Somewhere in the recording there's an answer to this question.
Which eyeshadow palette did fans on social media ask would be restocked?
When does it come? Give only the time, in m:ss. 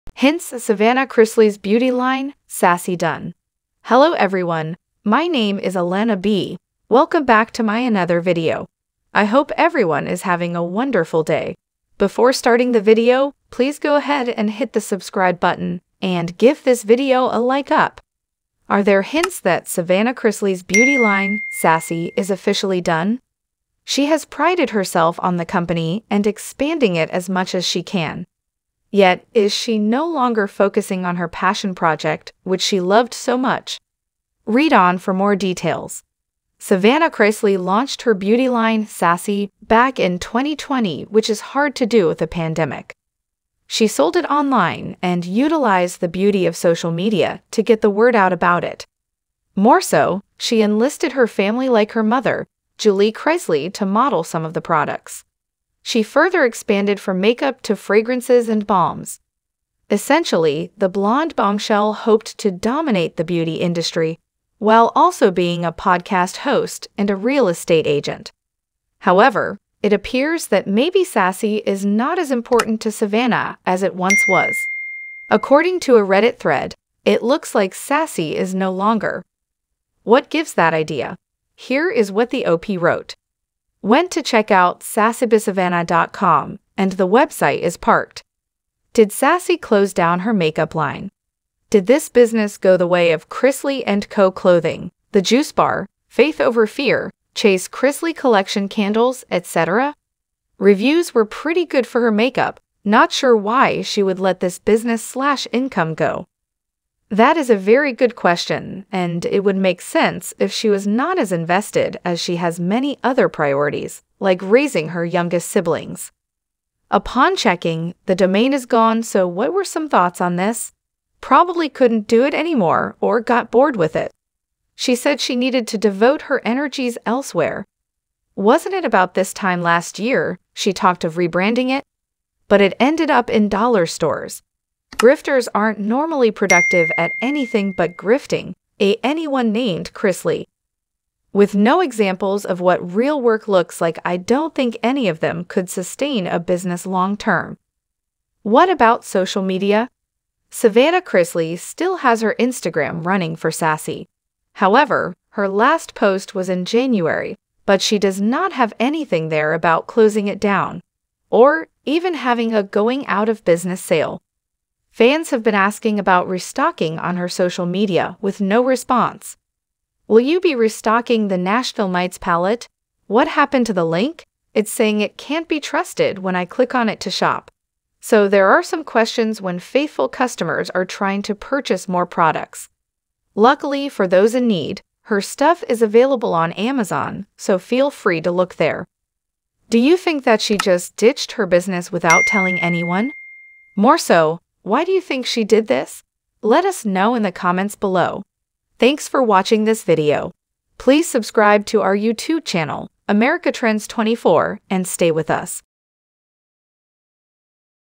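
2:51.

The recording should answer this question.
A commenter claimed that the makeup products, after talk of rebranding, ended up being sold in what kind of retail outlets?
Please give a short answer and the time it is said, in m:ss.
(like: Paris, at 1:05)
dollar stores, at 2:13.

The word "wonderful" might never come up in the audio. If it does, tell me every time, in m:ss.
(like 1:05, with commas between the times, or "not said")
0:10.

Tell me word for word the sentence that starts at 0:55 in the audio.
She further expanded from makeup to fragrances and balms.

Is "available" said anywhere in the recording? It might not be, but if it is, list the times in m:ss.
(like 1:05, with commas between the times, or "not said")
3:05.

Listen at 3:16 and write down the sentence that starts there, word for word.
Let us know in the comments below.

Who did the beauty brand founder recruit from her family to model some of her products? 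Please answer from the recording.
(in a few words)
Julie Chrisley.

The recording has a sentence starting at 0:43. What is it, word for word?
She sold it online and utilized the beauty of social media to get the word out about it.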